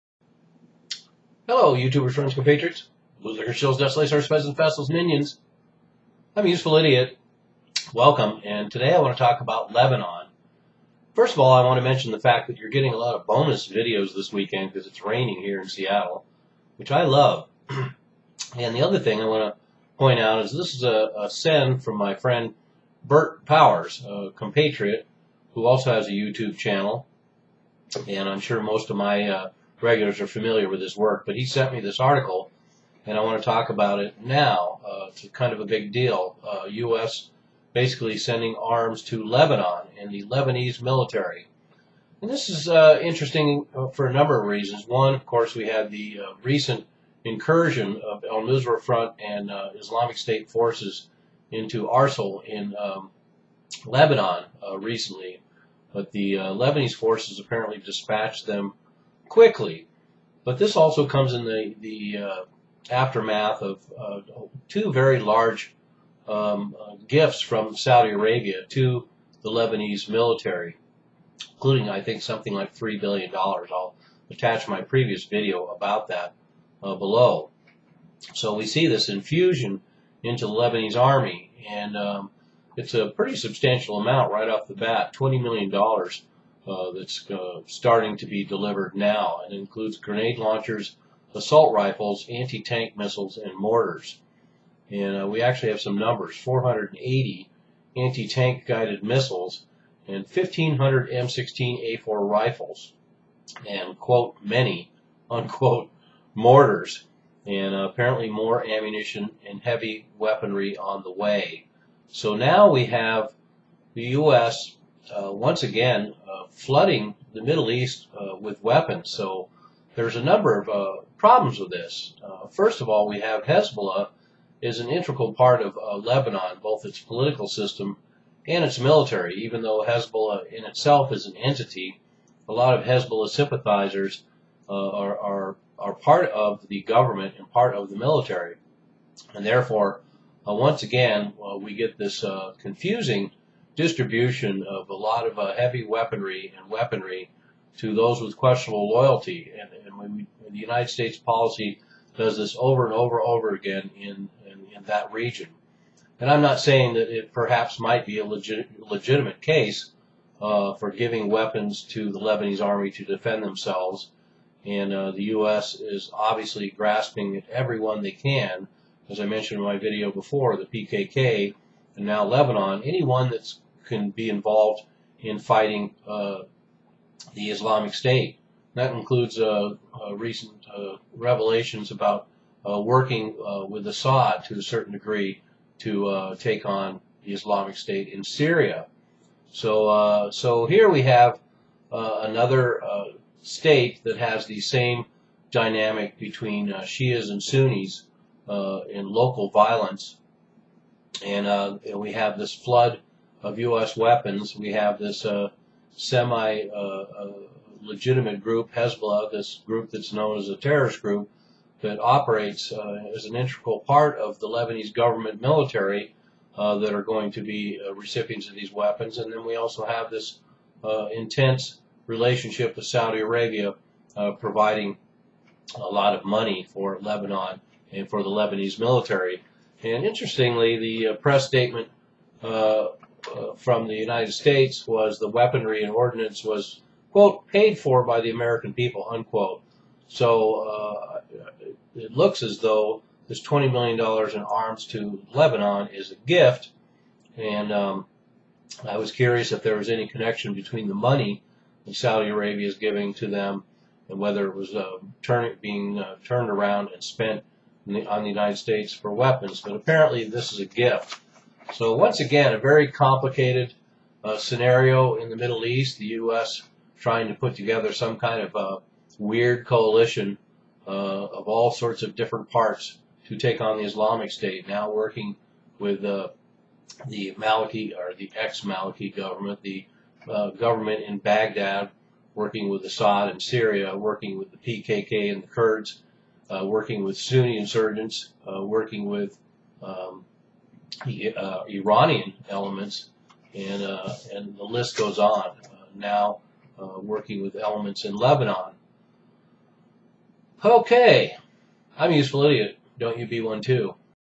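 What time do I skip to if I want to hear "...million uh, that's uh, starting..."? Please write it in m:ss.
1:25.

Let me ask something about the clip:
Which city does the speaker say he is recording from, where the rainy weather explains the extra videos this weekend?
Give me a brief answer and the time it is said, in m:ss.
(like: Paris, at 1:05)
Seattle, at 0:15.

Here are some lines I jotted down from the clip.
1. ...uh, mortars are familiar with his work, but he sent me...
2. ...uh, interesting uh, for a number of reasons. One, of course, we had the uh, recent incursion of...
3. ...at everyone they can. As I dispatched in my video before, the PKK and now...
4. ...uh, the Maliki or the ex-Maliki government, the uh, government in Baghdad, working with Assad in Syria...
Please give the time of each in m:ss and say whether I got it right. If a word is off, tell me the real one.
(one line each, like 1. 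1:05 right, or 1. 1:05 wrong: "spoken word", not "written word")
1. 0:29 wrong: "regulars", not "mortars"
2. 0:42 right
3. 2:47 wrong: "mentioned", not "dispatched"
4. 4:36 right.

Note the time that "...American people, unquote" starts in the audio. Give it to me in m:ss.
3:58.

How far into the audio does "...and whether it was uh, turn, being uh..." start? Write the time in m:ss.
4:14.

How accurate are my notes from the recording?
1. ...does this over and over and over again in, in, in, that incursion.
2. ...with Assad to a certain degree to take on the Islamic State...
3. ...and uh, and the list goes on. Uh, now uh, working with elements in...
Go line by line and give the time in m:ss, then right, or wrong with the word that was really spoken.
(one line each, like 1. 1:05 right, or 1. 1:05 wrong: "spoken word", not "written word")
1. 2:32 wrong: "region", not "incursion"
2. 3:03 right
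3. 4:53 right.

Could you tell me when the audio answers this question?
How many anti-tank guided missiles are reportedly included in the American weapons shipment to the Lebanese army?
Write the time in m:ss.
1:36.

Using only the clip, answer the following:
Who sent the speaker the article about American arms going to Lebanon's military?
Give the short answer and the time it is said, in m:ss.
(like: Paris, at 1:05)
Bert Powers, at 0:23.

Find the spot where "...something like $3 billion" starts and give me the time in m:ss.
1:12.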